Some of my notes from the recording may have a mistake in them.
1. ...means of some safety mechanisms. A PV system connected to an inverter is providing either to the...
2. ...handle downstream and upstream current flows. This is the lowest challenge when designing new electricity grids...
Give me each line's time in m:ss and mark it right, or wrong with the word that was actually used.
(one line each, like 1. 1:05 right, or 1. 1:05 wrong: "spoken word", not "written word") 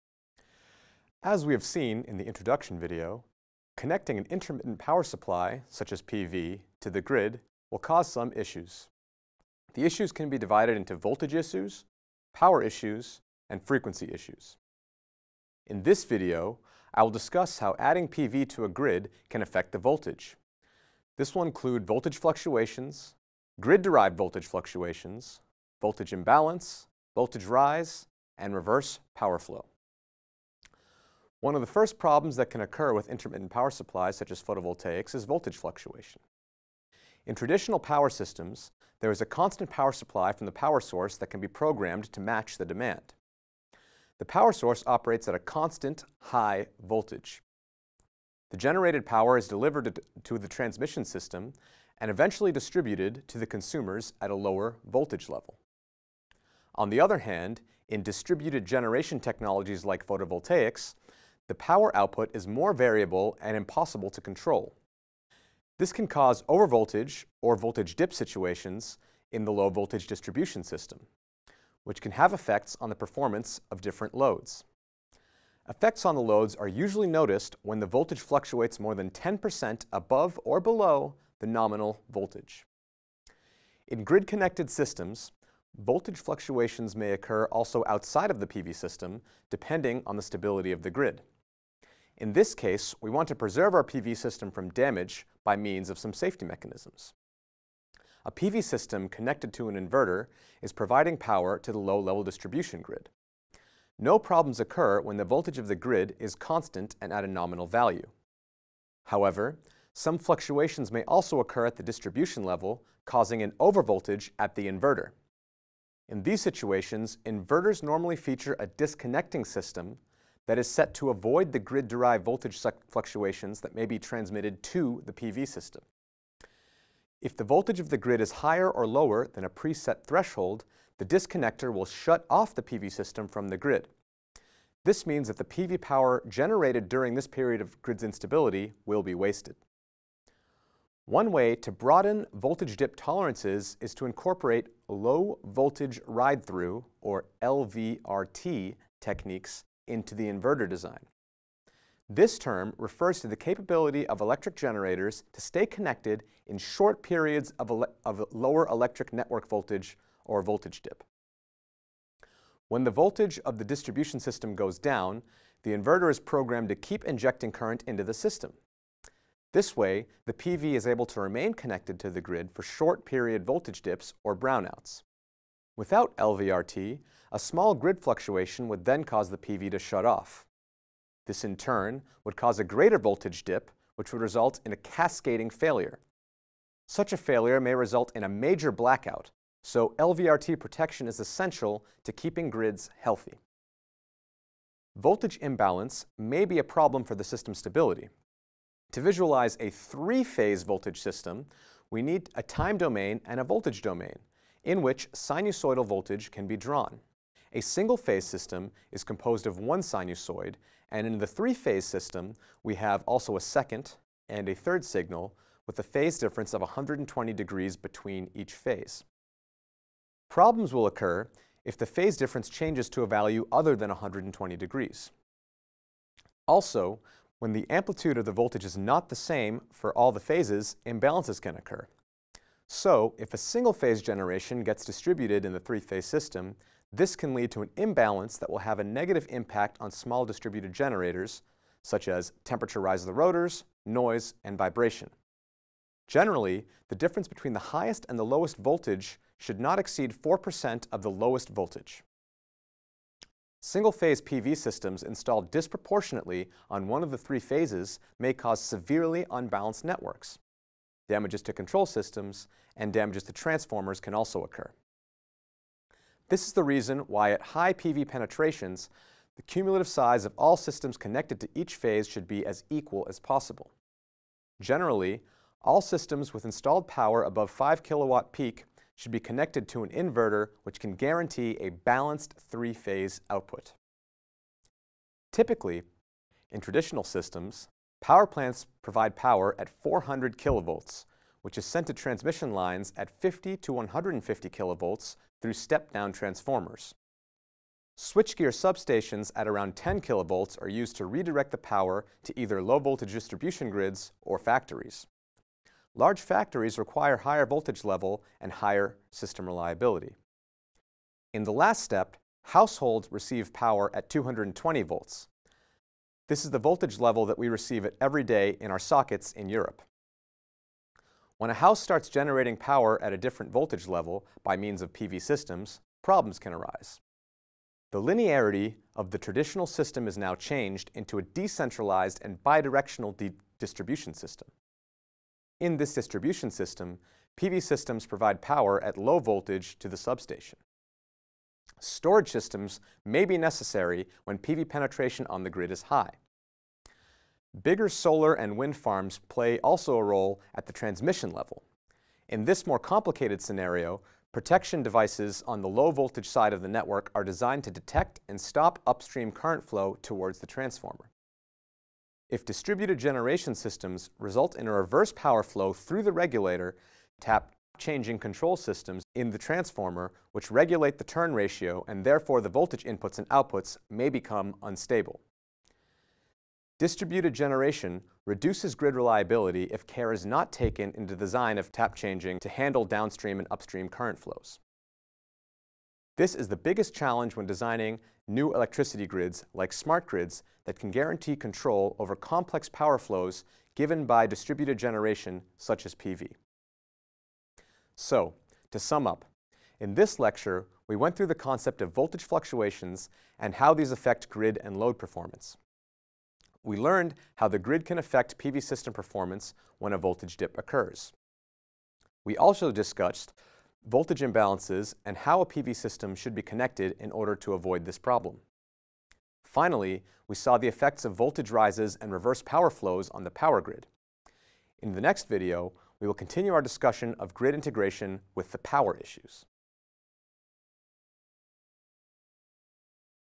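1. 1:35 wrong: "power", not "either"
2. 6:22 wrong: "biggest", not "lowest".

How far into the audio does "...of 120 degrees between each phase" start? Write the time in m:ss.
3:36.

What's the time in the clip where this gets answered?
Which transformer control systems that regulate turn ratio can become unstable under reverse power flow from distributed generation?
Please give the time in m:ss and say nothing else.
6:07.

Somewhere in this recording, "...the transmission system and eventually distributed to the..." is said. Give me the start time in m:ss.
0:50.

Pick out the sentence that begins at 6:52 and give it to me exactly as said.
We also discussed voltage imbalances and how a PV system should be connected in order to avoid this problem.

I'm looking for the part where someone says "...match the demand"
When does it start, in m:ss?
0:42.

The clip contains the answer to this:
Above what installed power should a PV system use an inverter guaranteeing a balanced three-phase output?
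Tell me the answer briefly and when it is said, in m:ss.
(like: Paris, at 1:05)
5 kilowatt peak, at 4:37.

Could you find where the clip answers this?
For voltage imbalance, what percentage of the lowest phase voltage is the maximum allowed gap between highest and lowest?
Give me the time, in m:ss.
4:10.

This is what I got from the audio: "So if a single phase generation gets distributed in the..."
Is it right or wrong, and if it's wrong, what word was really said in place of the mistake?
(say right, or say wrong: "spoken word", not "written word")
right.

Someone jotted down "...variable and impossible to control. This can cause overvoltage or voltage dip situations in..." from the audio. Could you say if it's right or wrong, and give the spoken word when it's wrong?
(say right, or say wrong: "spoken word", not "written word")
right.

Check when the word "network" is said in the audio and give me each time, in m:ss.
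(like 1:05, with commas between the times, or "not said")
2:39, 4:19, 5:56.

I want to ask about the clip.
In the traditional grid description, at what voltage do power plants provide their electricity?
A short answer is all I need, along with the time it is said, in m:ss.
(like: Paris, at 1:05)
400 kilovolts, at 4:49.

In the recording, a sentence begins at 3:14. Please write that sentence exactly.
Voltage imbalance may be a problem for the system's stability.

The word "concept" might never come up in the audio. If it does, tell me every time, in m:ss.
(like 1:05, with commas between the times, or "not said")
6:41.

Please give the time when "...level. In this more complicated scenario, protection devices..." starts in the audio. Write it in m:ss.
5:51.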